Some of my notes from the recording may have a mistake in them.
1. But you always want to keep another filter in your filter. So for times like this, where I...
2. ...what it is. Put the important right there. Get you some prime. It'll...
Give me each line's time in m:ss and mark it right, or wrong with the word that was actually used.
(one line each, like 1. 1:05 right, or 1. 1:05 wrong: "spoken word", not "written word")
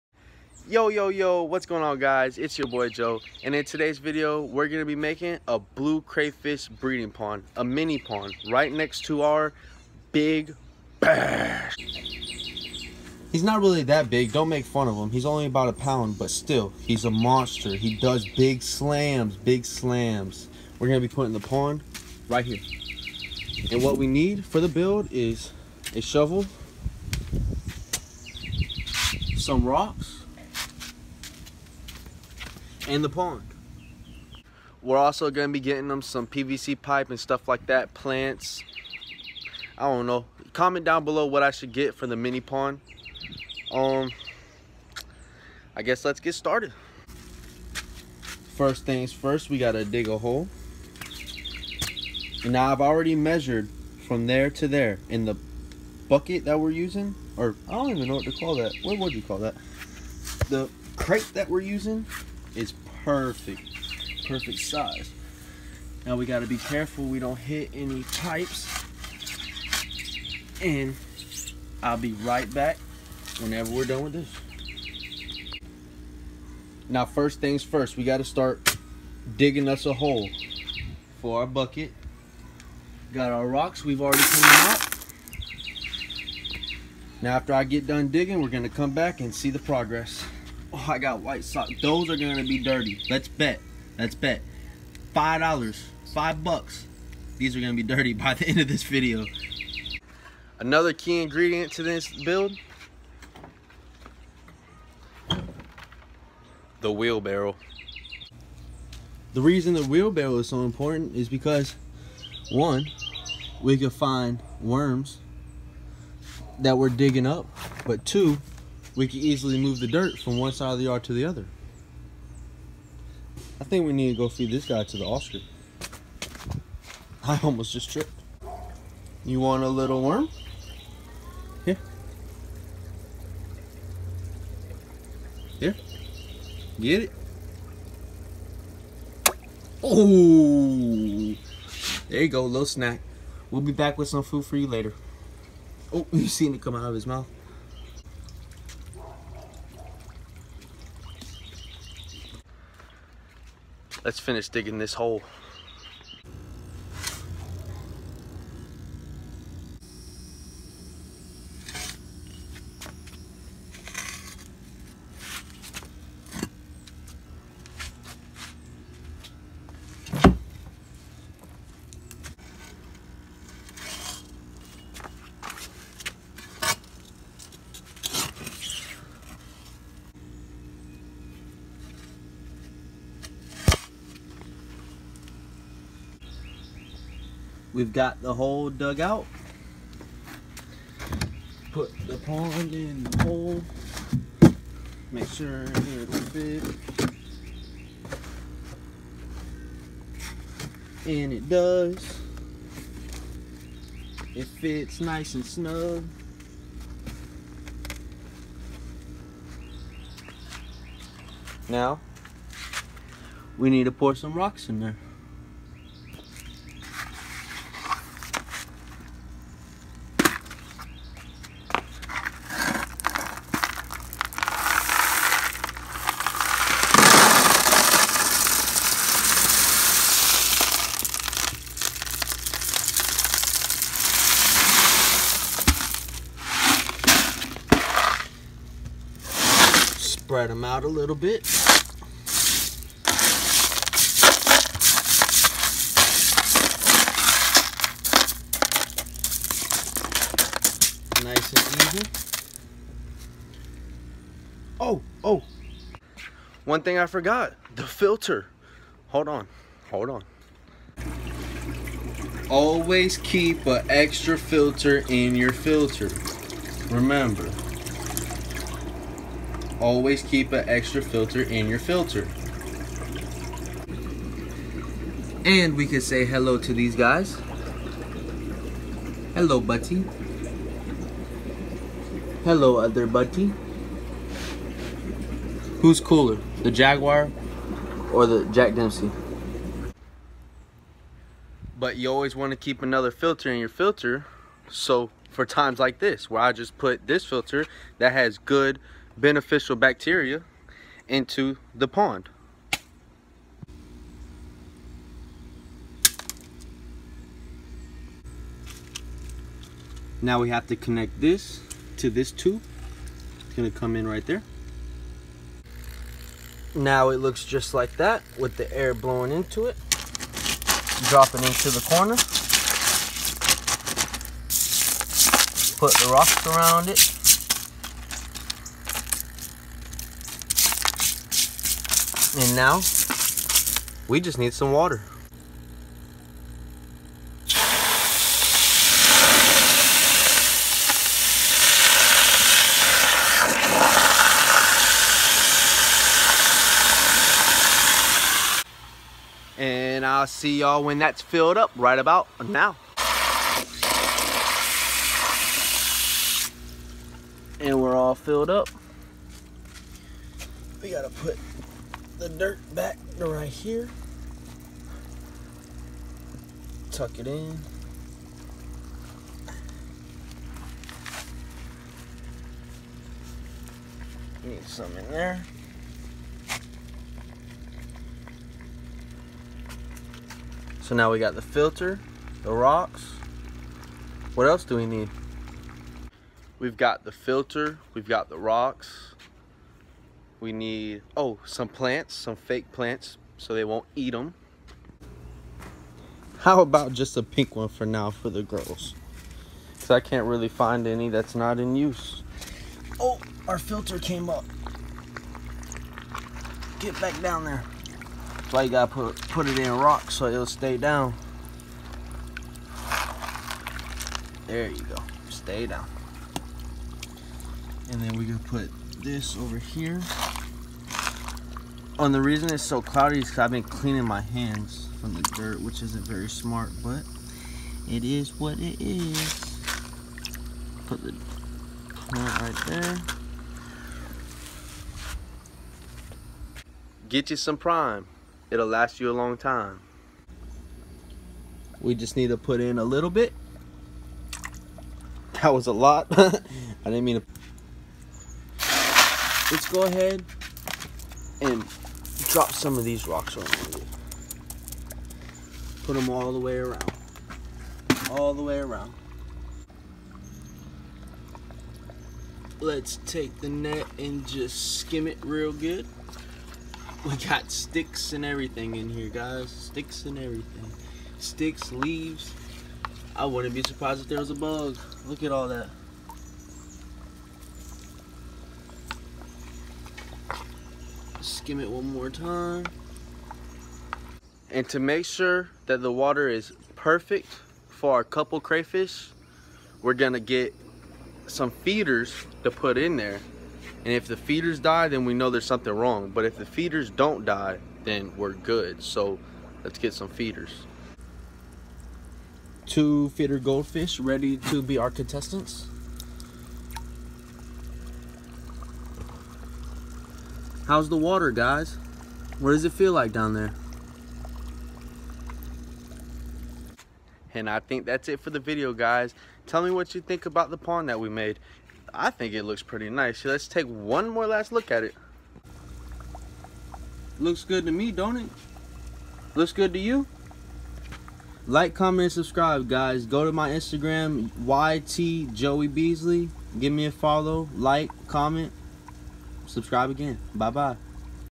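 1. 4:51 right
2. 7:08 wrong: "plant", not "important".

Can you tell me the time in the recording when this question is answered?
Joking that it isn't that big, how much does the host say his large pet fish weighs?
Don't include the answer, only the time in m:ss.
0:15.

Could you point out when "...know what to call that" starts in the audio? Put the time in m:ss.
0:58.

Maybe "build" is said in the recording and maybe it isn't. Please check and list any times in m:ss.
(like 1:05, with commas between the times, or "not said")
0:24, 1:42.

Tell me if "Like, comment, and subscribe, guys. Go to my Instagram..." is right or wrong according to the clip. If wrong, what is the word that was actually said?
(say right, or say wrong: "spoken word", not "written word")
right.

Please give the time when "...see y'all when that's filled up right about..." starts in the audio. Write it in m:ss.
5:50.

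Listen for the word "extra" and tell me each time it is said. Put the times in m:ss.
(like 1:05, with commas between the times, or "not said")
4:23, 4:30.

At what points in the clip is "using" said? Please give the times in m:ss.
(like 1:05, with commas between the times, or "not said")
0:56, 1:01.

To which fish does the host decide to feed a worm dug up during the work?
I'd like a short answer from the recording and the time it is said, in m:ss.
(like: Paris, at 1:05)
the Oscar, at 2:04.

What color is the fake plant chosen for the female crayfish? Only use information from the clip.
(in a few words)
pink.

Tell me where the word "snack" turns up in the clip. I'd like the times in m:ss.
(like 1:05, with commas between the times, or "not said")
2:22.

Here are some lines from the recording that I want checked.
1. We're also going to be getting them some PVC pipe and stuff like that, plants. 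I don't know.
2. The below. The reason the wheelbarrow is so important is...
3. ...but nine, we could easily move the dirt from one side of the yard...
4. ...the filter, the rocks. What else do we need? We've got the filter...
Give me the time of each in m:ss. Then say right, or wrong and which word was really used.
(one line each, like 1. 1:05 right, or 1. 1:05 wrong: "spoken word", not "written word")
1. 0:34 right
2. 1:46 wrong: "wheelbarrow", not "below"
3. 1:57 wrong: "two", not "nine"
4. 6:21 right.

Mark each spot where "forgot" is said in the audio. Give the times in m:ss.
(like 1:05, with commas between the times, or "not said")
4:17.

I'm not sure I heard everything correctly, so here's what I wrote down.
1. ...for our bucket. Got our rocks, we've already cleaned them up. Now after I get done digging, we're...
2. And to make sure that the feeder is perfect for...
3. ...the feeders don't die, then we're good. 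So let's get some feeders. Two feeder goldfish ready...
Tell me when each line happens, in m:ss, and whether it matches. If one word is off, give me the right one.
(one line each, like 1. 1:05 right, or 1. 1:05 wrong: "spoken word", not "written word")
1. 1:21 right
2. 8:04 wrong: "water", not "feeder"
3. 8:16 right.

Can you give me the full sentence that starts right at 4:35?
And we can say hello to these guys.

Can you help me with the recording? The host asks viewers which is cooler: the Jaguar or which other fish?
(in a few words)
Jack Dempsey.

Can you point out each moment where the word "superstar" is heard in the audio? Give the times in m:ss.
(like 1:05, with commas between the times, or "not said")
not said.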